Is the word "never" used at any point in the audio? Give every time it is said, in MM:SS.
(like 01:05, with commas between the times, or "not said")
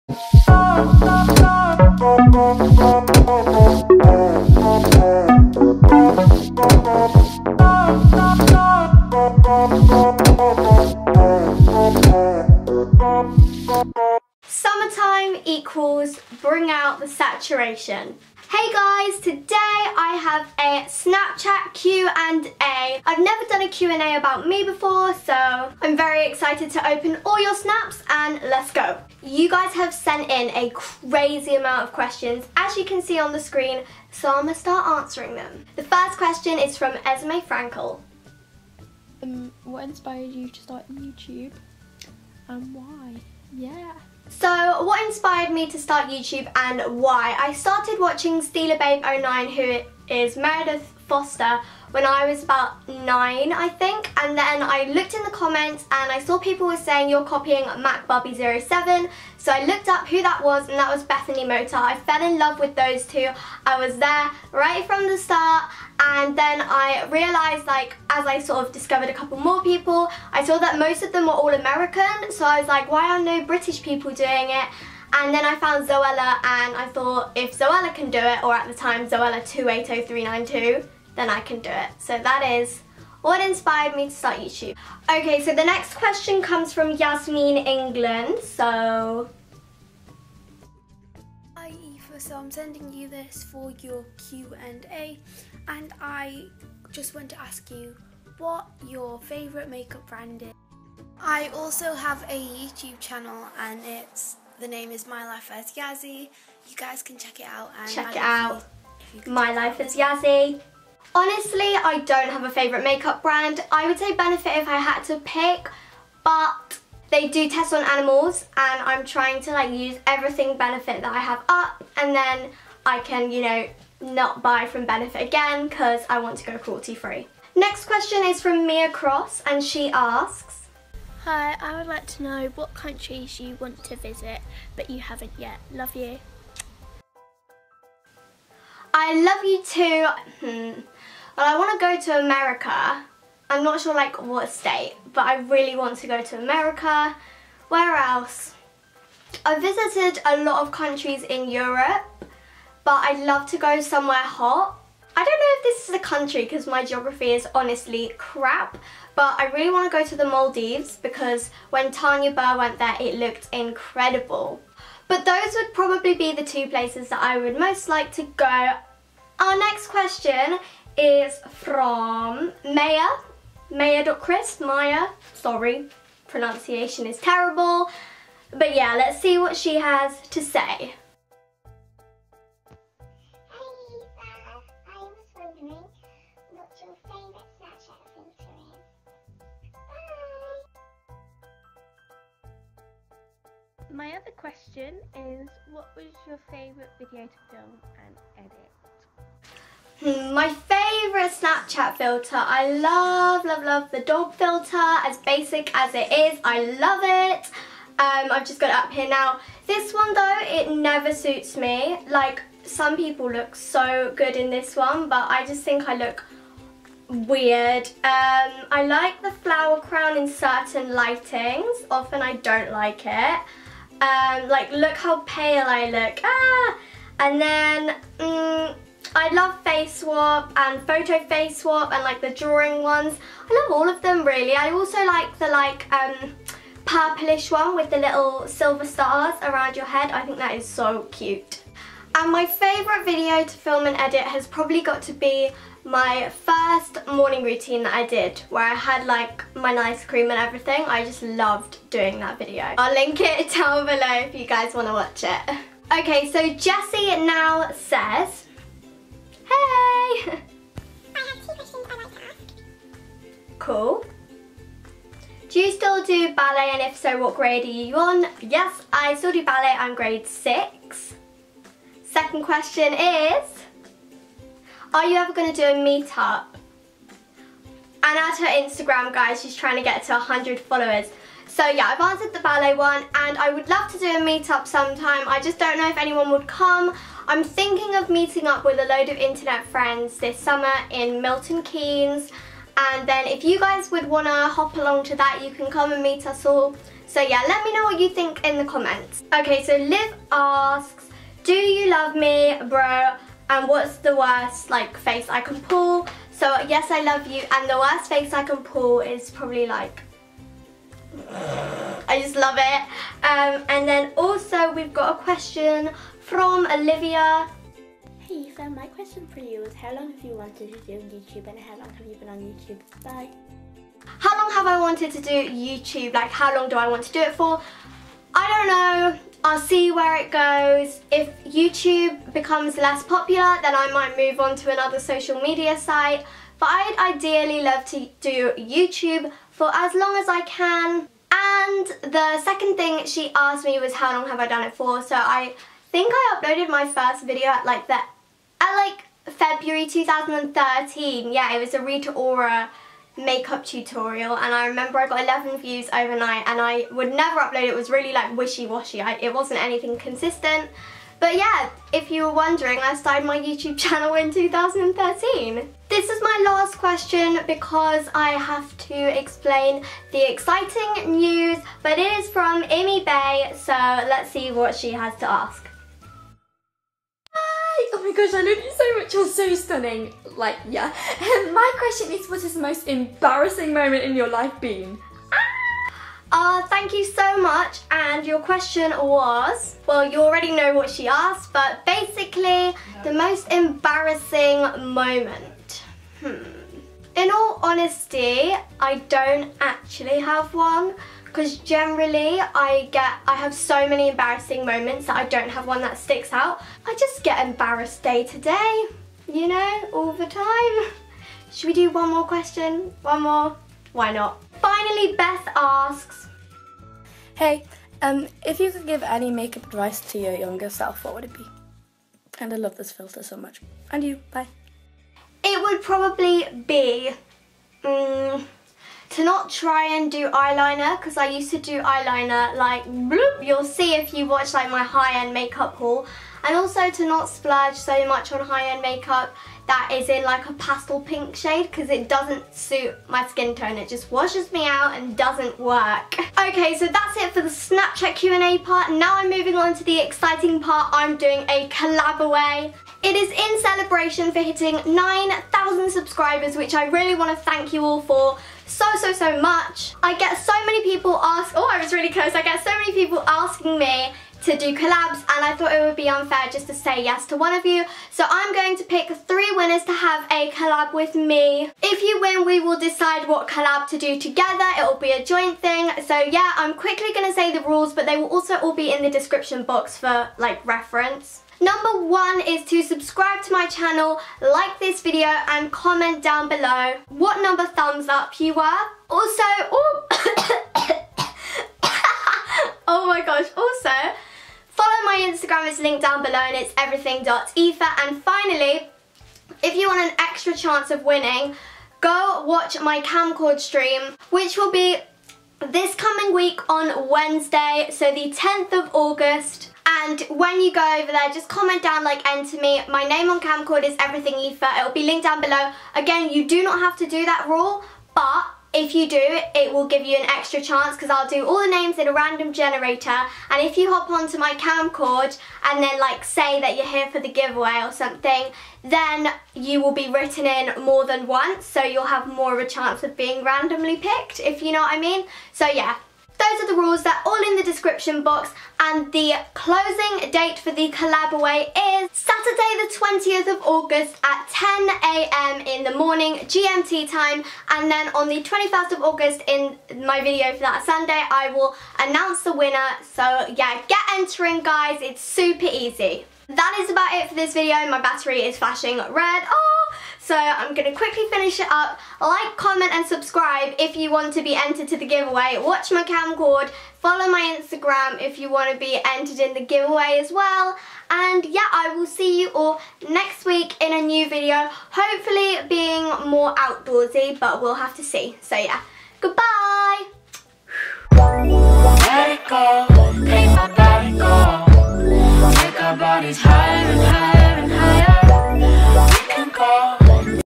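00:23, 03:30, 05:57.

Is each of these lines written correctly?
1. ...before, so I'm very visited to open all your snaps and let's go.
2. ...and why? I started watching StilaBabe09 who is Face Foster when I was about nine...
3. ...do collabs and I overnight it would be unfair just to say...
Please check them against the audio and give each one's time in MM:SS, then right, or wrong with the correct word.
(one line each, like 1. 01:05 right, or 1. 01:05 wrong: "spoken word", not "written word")
1. 00:24 wrong: "excited", not "visited"
2. 00:46 wrong: "Meredith", not "Face"
3. 07:44 wrong: "thought", not "overnight".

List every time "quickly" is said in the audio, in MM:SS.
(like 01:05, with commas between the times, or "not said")
07:56, 09:20.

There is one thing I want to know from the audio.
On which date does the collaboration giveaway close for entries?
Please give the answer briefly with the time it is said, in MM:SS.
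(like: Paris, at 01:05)
20th of August, at 09:02.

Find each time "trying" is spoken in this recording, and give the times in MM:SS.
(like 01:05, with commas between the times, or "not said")
01:59, 04:39.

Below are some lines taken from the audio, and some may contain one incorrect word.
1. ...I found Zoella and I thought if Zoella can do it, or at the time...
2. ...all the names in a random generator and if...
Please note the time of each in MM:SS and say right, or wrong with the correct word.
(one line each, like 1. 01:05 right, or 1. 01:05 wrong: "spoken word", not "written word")
1. 01:15 right
2. 08:41 right.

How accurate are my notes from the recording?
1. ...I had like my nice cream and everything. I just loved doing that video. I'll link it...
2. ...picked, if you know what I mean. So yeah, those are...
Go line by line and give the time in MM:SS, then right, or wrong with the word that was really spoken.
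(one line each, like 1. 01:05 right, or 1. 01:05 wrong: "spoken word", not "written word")
1. 04:08 right
2. 08:53 right.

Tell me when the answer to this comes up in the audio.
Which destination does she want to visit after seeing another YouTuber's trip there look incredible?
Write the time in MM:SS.
02:40.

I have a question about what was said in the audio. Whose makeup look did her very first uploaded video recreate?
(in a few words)
Rita Ora.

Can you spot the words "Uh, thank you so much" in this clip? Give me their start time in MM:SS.
06:26.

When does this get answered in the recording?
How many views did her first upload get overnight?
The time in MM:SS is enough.
05:55.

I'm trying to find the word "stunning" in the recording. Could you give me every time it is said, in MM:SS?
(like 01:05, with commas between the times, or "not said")
06:19.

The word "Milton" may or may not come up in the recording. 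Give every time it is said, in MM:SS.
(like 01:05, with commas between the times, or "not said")
04:51.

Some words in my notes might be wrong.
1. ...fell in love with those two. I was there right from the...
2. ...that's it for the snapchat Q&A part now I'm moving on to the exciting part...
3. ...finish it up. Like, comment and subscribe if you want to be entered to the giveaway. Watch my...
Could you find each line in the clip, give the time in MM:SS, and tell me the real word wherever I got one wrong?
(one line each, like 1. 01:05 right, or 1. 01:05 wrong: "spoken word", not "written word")
1. 01:01 right
2. 07:26 right
3. 09:21 right.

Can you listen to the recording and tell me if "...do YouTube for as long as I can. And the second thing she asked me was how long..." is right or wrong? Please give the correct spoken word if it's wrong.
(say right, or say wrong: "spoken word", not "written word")
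right.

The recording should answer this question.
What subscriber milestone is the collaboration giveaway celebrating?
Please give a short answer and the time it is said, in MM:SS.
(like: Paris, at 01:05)
9,000, at 07:34.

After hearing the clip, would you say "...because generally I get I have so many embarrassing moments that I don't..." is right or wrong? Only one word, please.
right.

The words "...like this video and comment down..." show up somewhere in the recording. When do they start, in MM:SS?
08:04.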